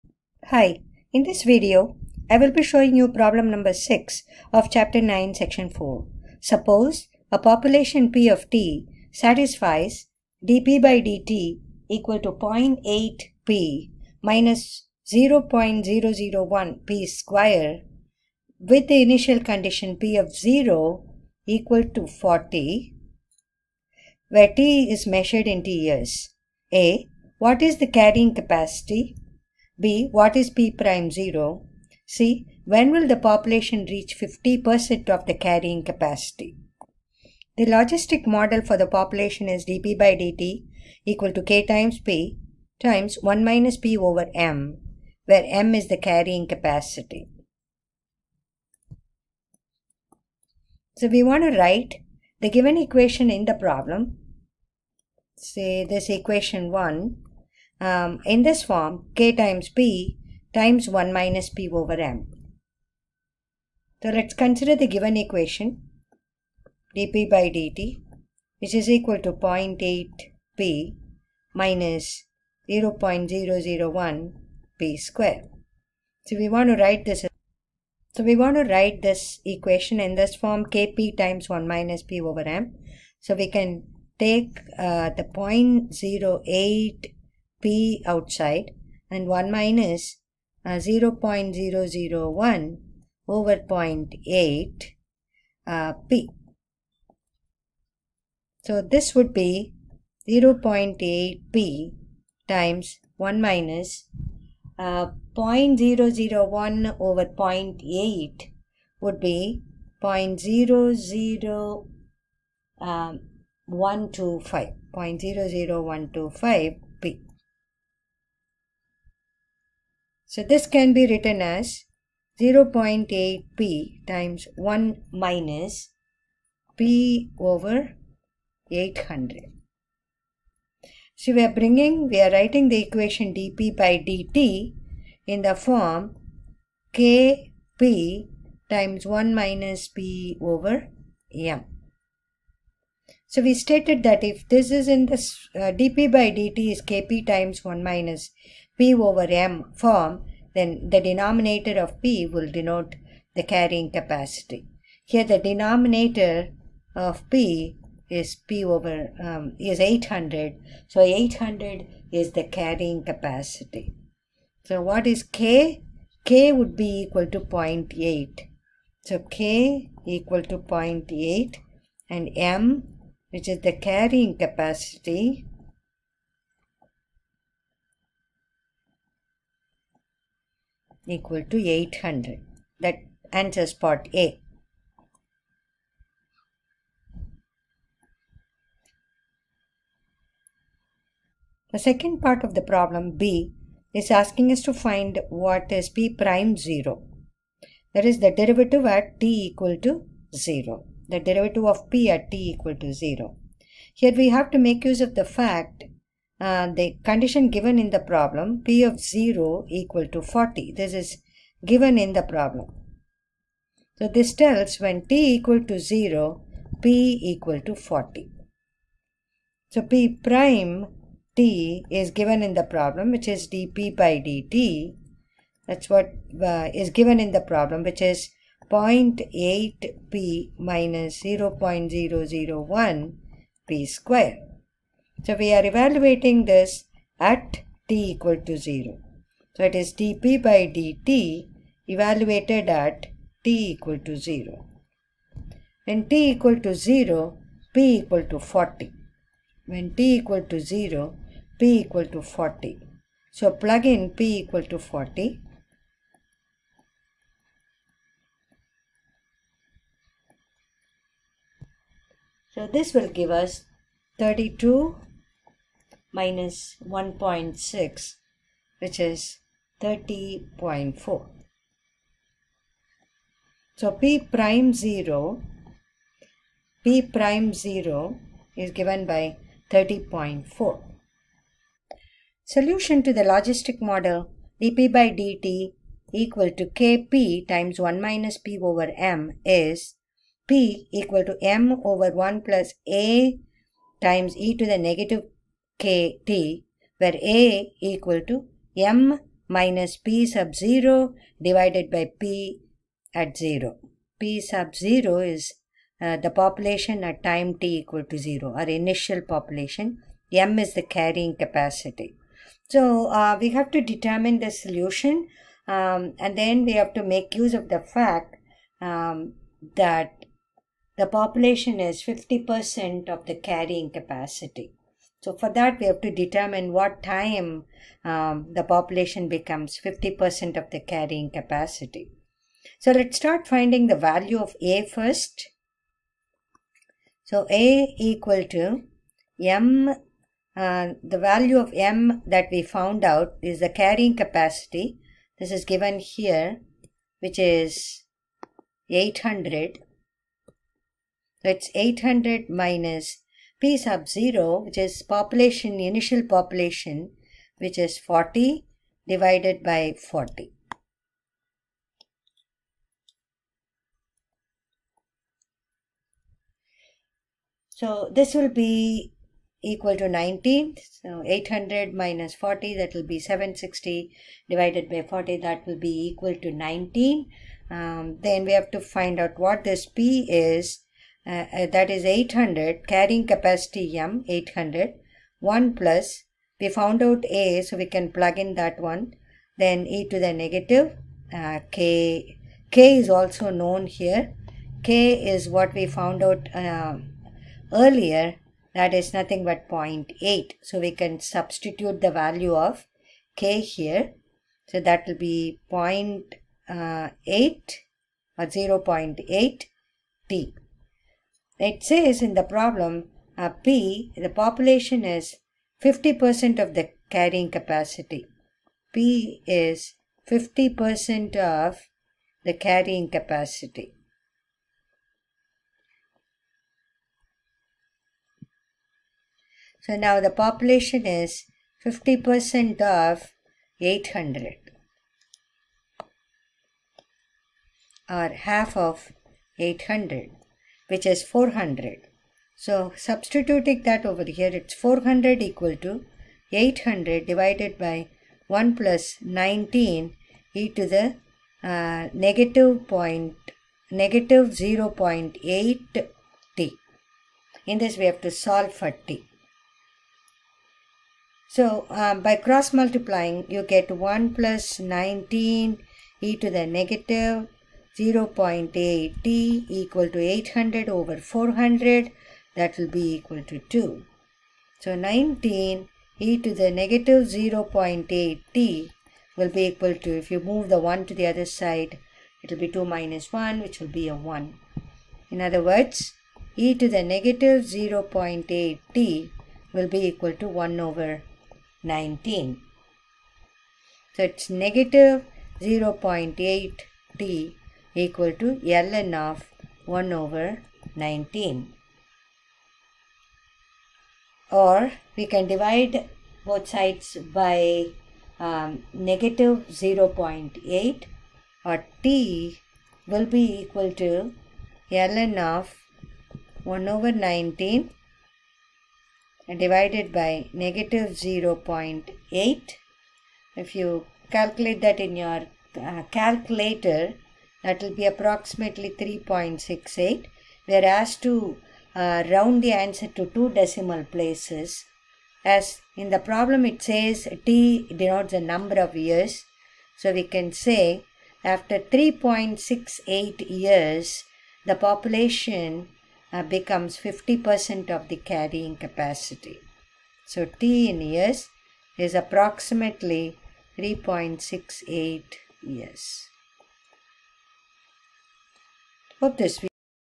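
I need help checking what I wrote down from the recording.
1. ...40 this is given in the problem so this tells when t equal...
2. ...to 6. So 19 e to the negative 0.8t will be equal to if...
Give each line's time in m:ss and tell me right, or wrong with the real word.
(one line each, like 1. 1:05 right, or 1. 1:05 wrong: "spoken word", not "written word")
1. 3:30 right
2. 7:53 wrong: "2", not "6".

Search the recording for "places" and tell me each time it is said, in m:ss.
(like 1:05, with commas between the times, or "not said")
8:54.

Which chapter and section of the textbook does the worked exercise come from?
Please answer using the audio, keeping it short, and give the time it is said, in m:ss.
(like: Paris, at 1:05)
Chapter 9 section 4, at 0:04.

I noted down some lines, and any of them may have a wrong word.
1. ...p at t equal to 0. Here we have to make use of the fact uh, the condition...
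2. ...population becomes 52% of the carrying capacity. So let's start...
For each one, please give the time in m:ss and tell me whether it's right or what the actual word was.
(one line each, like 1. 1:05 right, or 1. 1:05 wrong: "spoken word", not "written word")
1. 3:21 right
2. 5:28 wrong: "50", not "52".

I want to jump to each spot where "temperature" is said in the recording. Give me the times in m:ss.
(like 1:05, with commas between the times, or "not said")
not said.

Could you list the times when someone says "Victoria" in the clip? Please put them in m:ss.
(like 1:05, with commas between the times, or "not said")
not said.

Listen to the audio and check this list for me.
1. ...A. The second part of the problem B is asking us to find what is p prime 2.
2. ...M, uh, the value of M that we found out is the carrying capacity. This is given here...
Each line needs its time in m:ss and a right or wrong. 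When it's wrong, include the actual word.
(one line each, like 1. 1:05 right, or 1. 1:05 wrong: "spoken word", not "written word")
1. 3:04 wrong: "0", not "2"
2. 5:39 right.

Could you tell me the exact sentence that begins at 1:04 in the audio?
So let's consider the given equation dp by dt which is equal to 0.8p minus 0.001 p square.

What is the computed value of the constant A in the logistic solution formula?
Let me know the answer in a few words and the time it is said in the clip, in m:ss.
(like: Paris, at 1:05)
19, at 6:07.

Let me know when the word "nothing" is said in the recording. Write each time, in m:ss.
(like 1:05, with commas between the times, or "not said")
6:39.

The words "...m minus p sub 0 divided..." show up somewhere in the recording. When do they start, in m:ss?
4:58.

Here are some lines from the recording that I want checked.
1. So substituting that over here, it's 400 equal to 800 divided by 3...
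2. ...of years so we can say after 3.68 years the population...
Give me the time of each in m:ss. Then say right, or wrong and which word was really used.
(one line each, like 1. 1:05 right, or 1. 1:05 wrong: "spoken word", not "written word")
1. 7:22 wrong: "1", not "3"
2. 8:58 right.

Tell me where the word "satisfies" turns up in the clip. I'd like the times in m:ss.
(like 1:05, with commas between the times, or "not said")
0:09.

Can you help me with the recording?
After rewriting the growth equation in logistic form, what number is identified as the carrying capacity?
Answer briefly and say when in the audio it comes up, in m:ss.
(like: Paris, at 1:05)
800, at 2:40.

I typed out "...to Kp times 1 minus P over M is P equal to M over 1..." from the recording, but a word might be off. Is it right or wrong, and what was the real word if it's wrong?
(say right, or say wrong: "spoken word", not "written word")
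right.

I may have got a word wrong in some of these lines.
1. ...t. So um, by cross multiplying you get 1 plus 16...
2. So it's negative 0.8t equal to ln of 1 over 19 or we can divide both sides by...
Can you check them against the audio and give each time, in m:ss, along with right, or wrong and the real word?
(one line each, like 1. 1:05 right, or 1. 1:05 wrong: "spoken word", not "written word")
1. 7:39 wrong: "19", not "16"
2. 8:14 right.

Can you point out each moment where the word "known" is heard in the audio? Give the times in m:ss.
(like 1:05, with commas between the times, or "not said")
6:33.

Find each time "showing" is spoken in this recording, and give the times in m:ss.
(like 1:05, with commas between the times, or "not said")
0:02.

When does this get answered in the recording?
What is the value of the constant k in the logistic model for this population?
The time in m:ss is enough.
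2:46.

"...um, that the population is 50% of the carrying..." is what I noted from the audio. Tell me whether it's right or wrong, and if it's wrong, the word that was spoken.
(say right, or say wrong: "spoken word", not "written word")
right.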